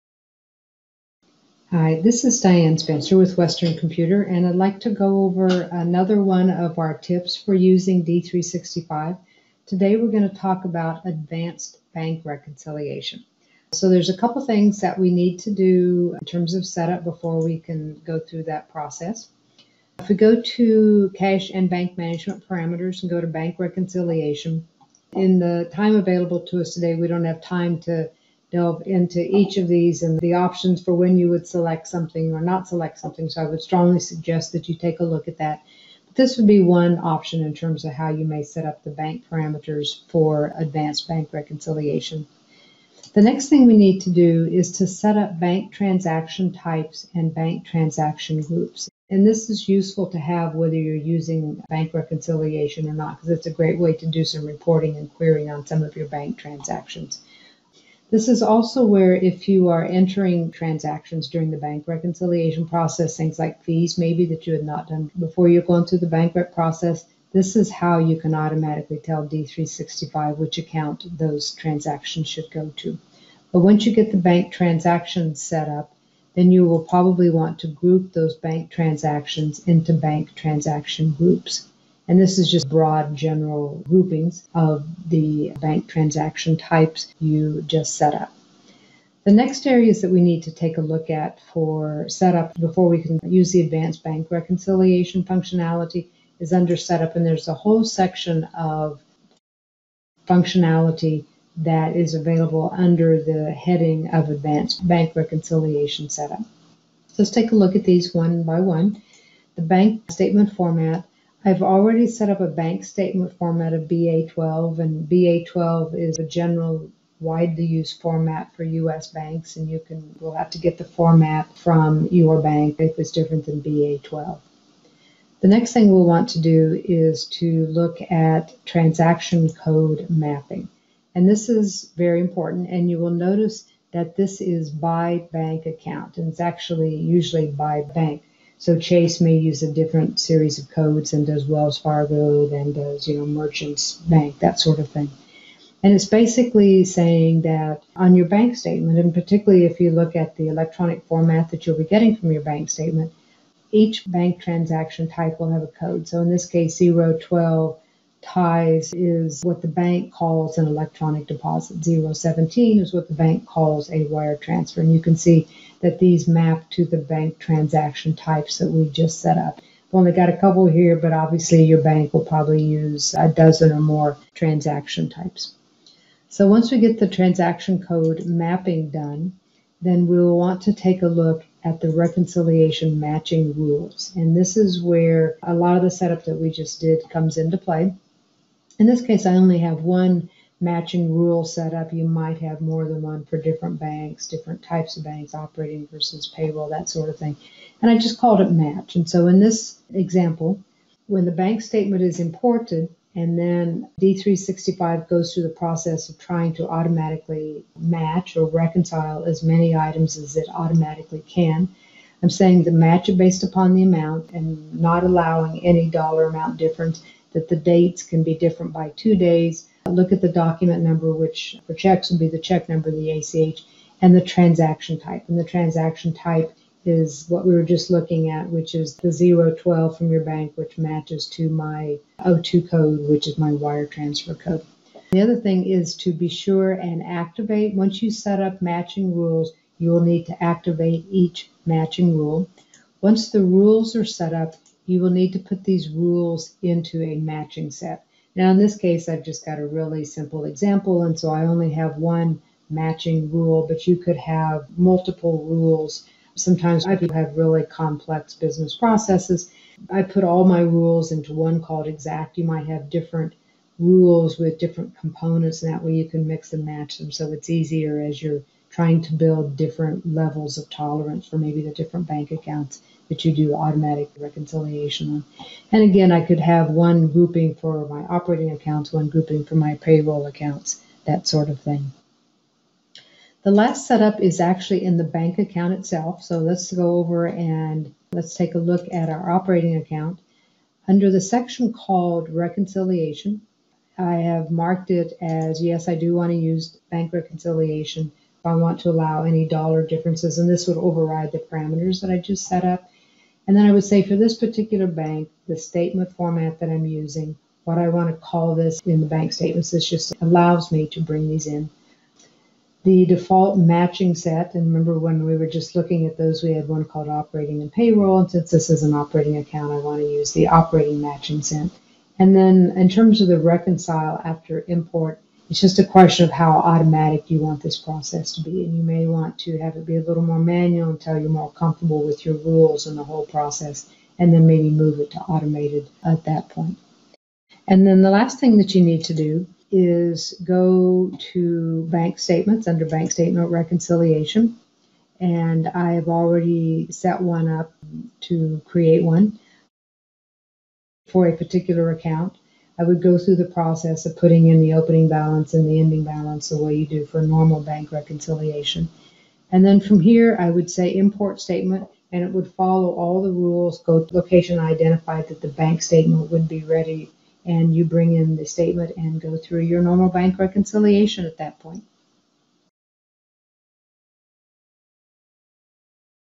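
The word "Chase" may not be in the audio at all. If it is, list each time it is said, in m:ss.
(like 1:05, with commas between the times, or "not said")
2:18.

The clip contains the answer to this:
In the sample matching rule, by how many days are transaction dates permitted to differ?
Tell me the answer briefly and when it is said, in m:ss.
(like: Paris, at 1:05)
2, at 3:38.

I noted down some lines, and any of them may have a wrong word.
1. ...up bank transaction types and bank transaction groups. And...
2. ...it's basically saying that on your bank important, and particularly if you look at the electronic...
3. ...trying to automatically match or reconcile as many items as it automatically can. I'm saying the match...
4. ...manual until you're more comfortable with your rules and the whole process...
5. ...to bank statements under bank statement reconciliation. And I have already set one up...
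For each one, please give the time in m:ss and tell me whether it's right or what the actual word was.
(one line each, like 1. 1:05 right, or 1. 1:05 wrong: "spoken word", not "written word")
1. 0:45 right
2. 2:25 wrong: "statement", not "important"
3. 3:26 right
4. 5:30 right
5. 5:41 right.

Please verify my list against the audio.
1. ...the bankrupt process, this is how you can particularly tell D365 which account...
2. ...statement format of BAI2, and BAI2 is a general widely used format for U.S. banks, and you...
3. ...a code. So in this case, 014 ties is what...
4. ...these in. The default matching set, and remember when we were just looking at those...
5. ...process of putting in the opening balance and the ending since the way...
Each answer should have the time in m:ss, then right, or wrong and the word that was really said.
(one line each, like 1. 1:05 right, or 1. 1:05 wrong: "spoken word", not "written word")
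1. 1:05 wrong: "automatically", not "particularly"
2. 1:52 right
3. 2:35 wrong: "012", not "014"
4. 5:11 right
5. 5:53 wrong: "balance", not "since".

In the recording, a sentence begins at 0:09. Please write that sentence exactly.
Today we're going to talk about advanced bank reconciliation.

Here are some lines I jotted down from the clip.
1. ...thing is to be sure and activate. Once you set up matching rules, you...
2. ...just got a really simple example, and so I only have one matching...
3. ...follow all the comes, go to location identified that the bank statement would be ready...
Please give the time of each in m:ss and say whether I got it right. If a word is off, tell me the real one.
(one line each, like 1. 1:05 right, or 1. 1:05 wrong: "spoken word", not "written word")
1. 3:55 right
2. 4:09 right
3. 6:02 wrong: "rules", not "comes".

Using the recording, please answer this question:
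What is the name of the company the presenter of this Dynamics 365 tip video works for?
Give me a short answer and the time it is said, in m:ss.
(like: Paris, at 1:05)
Western Computer, at 0:03.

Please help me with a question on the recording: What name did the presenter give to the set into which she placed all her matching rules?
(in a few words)
exact.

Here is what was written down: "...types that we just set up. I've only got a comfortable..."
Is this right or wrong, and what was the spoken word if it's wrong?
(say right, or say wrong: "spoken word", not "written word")
wrong: "couple", not "comfortable".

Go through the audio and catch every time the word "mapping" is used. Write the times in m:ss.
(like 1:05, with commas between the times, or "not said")
2:10, 2:58.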